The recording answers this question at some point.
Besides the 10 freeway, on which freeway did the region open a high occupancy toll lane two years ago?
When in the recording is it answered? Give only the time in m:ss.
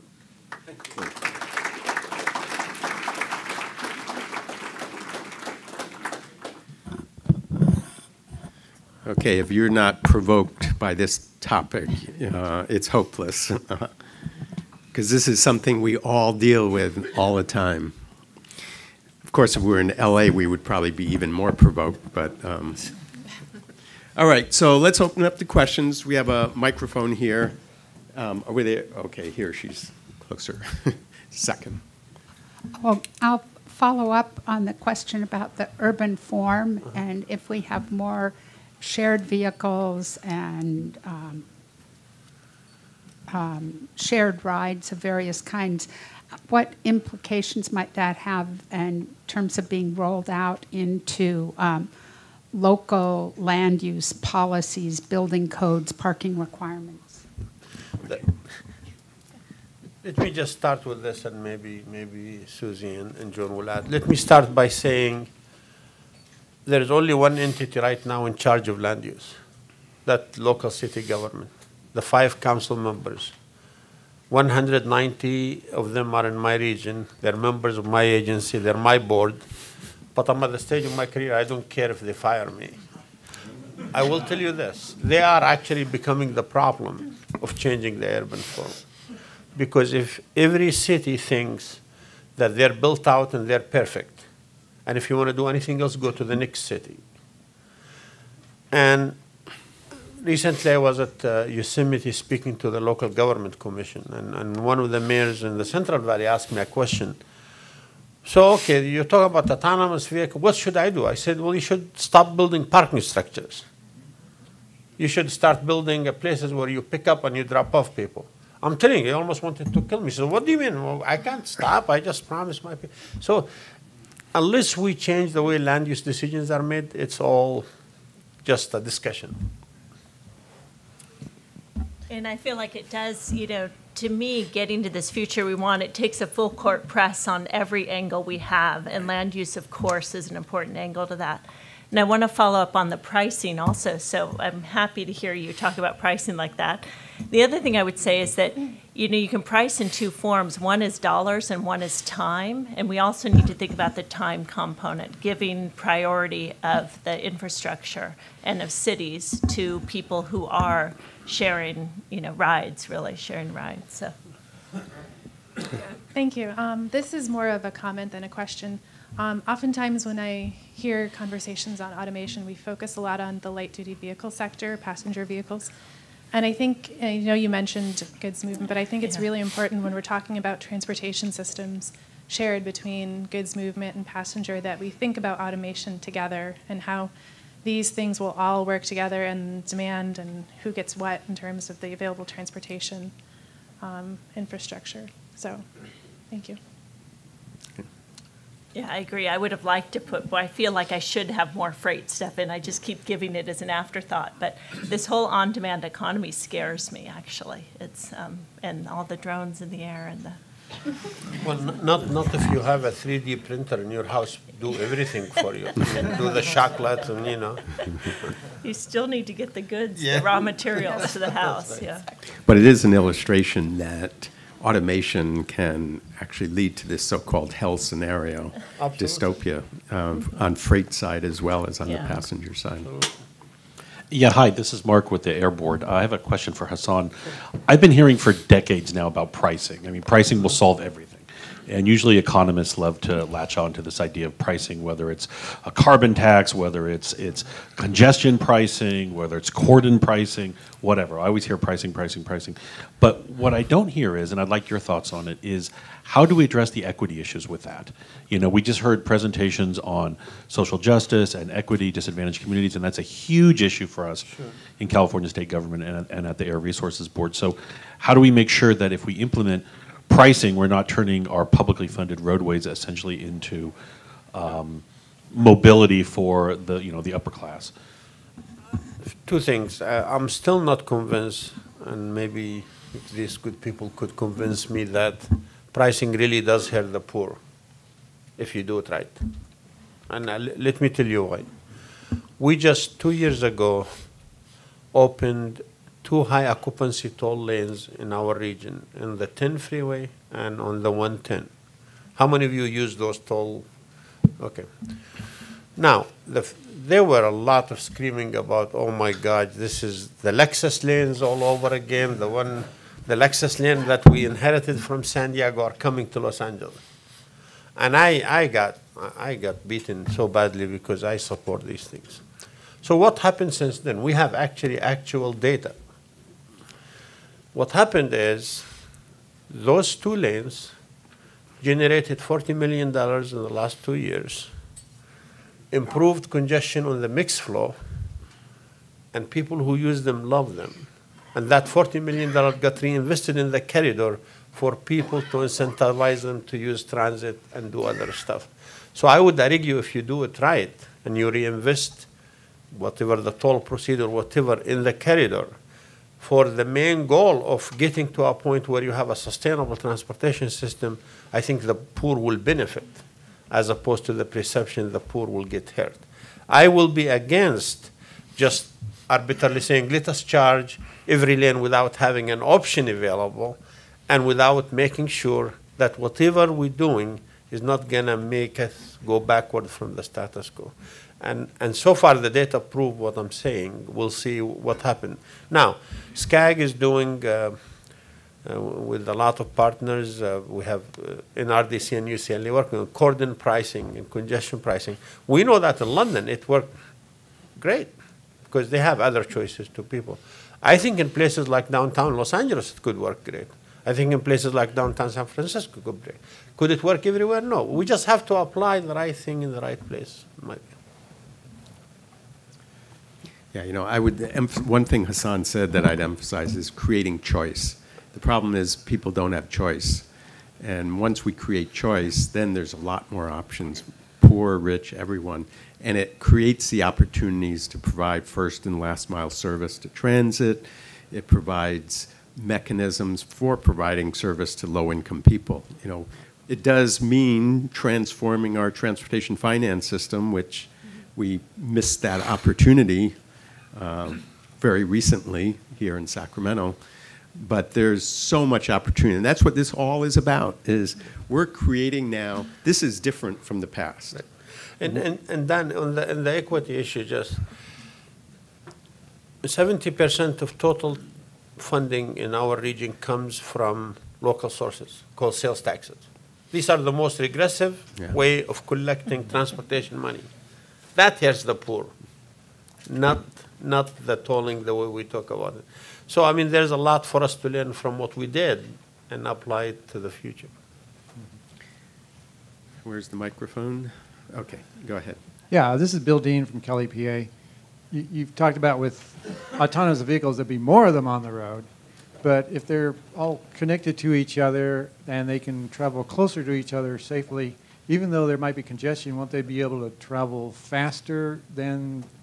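5:00.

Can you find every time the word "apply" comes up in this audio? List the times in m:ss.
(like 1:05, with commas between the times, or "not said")
6:48, 7:59.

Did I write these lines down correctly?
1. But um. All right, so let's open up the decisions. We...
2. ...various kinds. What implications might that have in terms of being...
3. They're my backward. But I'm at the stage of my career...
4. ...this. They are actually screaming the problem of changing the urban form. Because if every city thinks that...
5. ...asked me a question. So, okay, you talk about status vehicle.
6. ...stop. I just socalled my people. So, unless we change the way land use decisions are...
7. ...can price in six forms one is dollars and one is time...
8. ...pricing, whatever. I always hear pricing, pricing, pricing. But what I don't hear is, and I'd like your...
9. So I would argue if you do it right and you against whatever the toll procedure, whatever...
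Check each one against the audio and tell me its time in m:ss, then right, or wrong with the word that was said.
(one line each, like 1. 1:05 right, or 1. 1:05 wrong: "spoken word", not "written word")
1. 0:22 wrong: "questions", not "decisions"
2. 0:44 right
3. 1:18 wrong: "board", not "backward"
4. 1:24 wrong: "becoming", not "screaming"
5. 1:46 wrong: "autonomous", not "status"
6. 2:01 wrong: "promised", not "socalled"
7. 2:29 wrong: "two", not "six"
8. 4:09 right
9. 5:48 wrong: "reinvest", not "against".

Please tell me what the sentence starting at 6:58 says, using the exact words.
The problem is people don't have choice.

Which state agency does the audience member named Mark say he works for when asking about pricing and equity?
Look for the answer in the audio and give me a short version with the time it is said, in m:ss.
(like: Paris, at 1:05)
the Air Resources Board, at 3:55.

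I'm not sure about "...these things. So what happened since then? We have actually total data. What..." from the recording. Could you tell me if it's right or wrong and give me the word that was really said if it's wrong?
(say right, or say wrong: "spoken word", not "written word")
wrong: "actual", not "total".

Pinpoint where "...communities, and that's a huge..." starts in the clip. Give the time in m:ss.
4:22.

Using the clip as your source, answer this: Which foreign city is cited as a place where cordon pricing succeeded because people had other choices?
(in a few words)
London.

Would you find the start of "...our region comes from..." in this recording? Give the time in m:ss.
7:42.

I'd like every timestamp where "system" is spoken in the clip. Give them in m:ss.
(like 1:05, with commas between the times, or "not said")
3:01, 6:00, 7:19.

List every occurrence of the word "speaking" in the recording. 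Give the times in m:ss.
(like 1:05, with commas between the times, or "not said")
1:42.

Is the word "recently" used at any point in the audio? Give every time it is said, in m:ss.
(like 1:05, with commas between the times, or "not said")
1:40, 7:24.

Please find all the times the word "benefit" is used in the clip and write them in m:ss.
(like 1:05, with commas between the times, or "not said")
6:02.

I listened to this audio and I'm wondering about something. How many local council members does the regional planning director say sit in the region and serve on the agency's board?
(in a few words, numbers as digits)
190.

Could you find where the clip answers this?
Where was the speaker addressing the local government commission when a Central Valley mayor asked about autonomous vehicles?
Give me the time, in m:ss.
1:41.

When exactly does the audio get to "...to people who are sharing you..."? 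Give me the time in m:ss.
2:39.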